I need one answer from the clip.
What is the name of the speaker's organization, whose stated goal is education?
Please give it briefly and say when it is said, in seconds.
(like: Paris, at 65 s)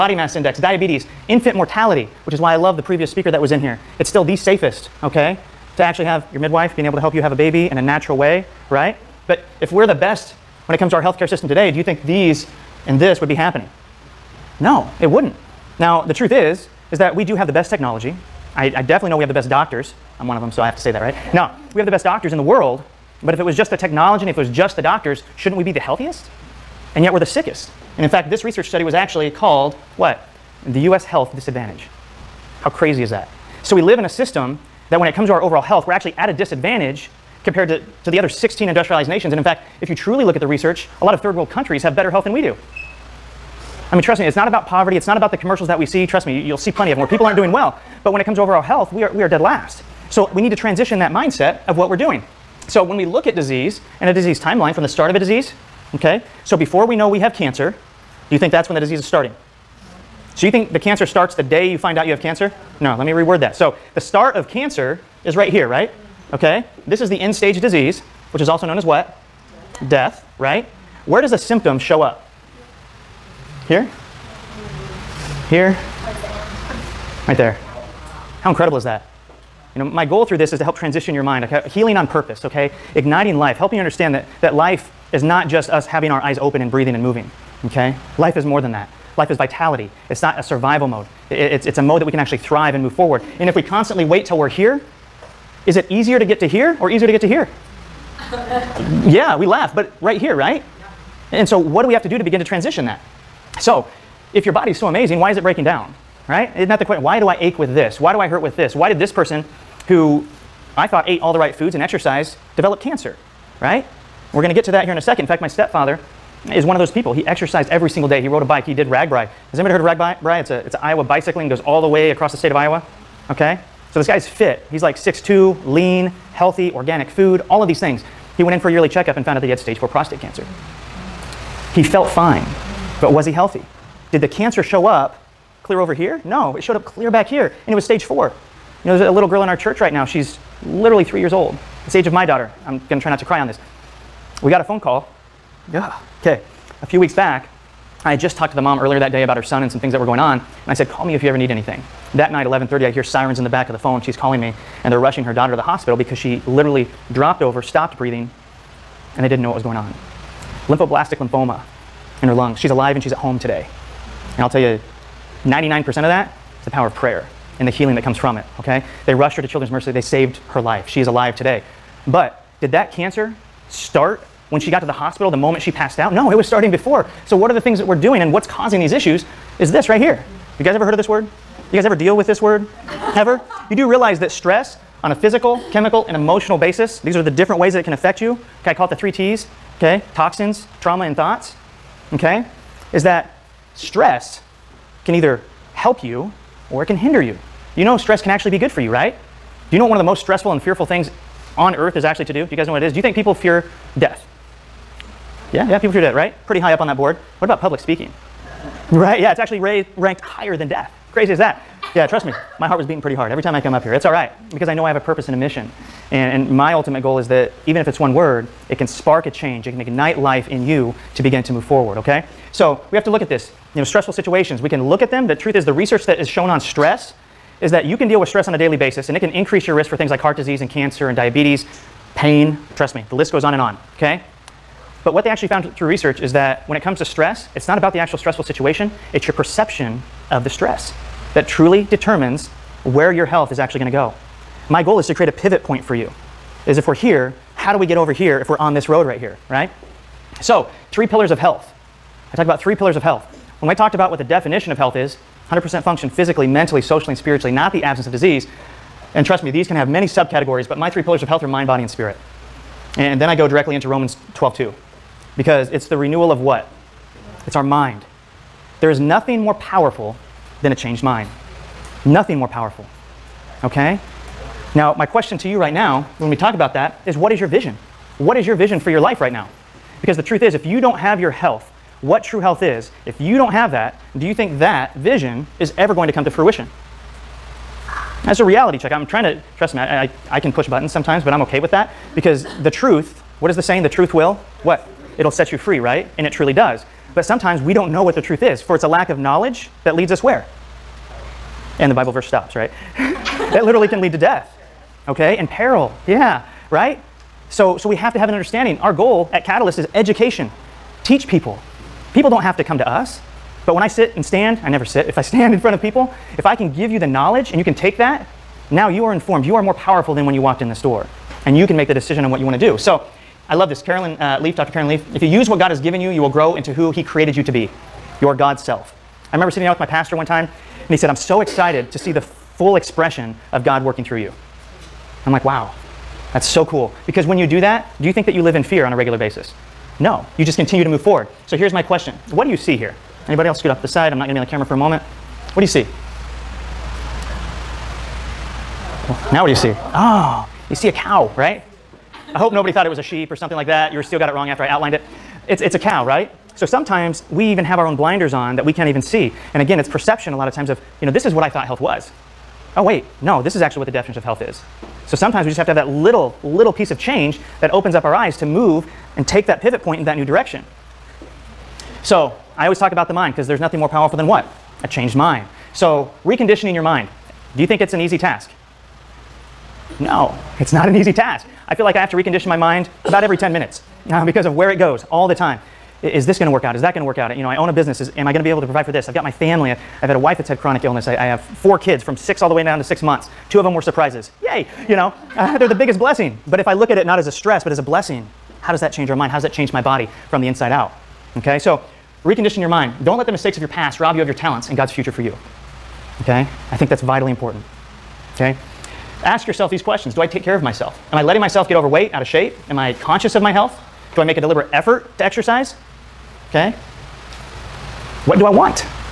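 Catalyst, at 309 s.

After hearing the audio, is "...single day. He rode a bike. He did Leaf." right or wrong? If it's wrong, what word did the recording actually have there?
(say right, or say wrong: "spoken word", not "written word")
wrong: "RAGBRAI", not "Leaf".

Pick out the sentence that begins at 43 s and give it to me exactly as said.
I mean, trust me, it's not about poverty.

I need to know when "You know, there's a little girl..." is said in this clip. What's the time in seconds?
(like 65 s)
138 s.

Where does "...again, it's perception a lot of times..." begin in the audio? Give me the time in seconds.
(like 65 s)
359 s.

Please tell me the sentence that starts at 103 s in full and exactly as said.
So, if your body's so amazing, why is it breaking down?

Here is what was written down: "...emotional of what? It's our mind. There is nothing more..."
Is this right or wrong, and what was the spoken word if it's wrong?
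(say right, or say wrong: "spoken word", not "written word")
wrong: "renewal", not "emotional".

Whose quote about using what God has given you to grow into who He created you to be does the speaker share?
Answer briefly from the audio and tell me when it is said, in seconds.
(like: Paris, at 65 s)
Dr. Caroline Leaf, at 324 s.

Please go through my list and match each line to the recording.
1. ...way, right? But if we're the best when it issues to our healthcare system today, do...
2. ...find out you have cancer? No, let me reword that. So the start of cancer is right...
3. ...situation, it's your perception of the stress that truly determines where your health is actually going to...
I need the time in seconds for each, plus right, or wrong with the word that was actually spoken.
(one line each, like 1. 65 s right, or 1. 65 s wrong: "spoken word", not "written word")
1. 8 s wrong: "comes", not "issues"
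2. 61 s right
3. 238 s right.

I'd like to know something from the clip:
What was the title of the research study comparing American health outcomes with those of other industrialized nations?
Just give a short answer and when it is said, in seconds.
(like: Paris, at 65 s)
The US health disadvantage, at 30 s.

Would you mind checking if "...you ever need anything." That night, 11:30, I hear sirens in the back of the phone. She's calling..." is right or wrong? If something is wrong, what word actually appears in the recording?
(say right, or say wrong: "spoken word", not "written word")
right.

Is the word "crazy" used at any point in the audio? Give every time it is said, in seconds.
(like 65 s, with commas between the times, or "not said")
32 s, 211 s.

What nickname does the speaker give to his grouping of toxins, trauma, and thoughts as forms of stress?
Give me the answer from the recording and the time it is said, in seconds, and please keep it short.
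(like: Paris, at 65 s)
the three T's, at 188 s.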